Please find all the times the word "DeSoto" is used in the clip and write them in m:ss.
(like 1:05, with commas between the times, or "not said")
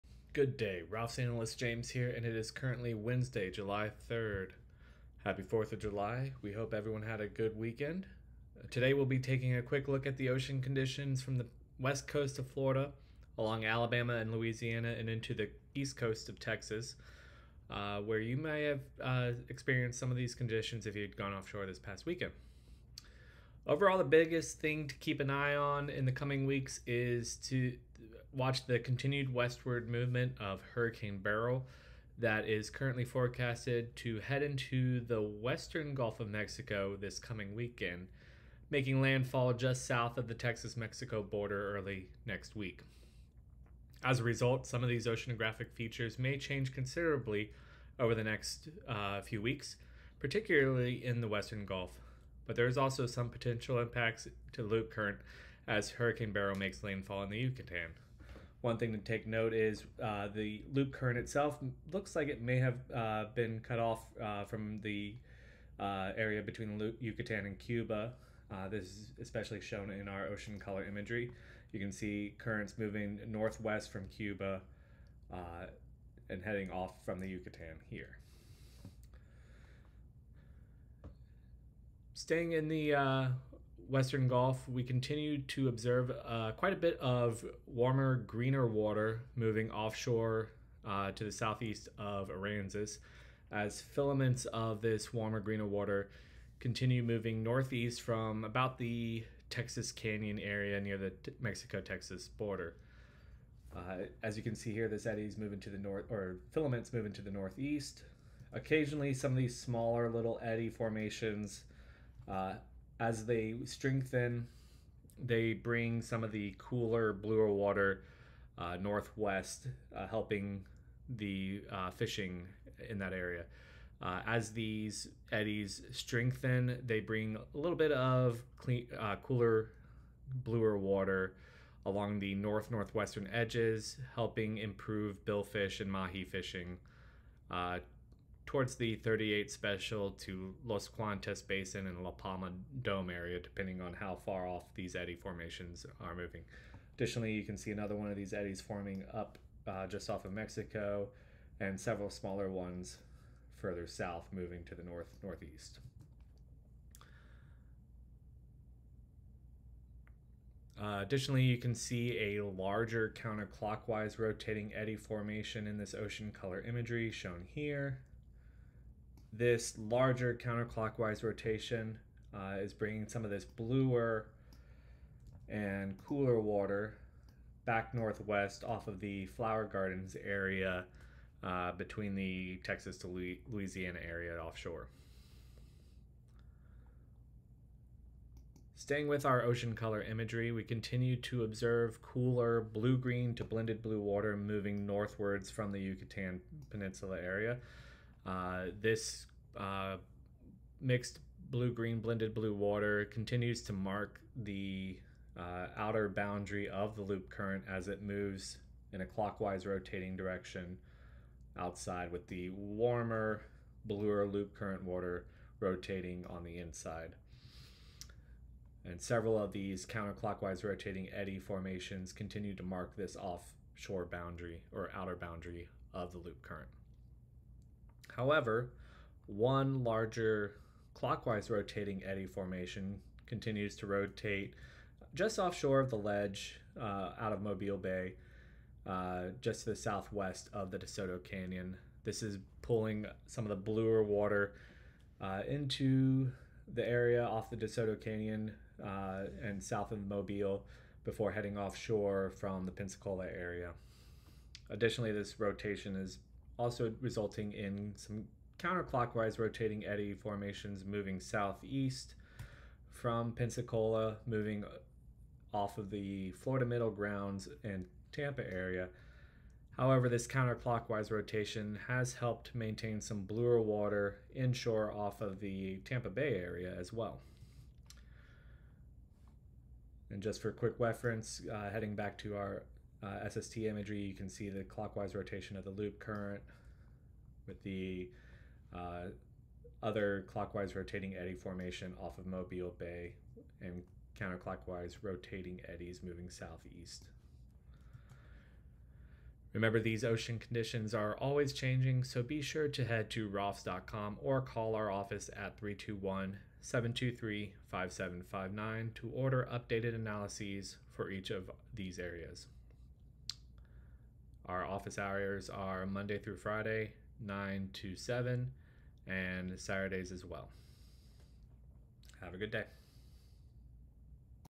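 4:00, 4:07.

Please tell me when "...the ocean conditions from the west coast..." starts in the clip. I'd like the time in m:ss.
0:10.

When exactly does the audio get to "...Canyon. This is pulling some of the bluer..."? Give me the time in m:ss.
4:01.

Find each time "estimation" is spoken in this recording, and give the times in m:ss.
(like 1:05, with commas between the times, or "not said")
not said.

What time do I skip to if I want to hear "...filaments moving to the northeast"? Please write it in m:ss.
1:46.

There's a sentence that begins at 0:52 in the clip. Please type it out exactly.
But there is also some potential impacts to loop current as Hurricane Beryl makes landfall in the Yucatan.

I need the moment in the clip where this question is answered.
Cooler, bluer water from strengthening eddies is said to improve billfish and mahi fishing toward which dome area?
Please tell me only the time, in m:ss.
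2:22.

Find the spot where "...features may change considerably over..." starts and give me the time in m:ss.
0:45.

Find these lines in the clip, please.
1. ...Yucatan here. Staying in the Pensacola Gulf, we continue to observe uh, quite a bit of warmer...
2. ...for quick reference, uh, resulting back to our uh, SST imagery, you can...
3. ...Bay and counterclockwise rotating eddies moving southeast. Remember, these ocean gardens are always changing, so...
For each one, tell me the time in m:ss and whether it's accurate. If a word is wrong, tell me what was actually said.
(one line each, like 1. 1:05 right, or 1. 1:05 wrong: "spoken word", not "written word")
1. 1:17 wrong: "Western", not "Pensacola"
2. 4:40 wrong: "heading", not "resulting"
3. 4:52 wrong: "conditions", not "gardens".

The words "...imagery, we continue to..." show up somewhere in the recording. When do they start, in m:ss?
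3:10.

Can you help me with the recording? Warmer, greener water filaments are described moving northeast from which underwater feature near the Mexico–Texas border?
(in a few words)
Texas Canyon.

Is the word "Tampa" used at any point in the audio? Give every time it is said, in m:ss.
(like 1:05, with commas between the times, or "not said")
4:28, 4:35.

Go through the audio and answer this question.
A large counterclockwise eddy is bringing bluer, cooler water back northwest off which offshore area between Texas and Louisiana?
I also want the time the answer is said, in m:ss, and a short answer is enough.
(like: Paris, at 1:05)
Flower Gardens, at 2:59.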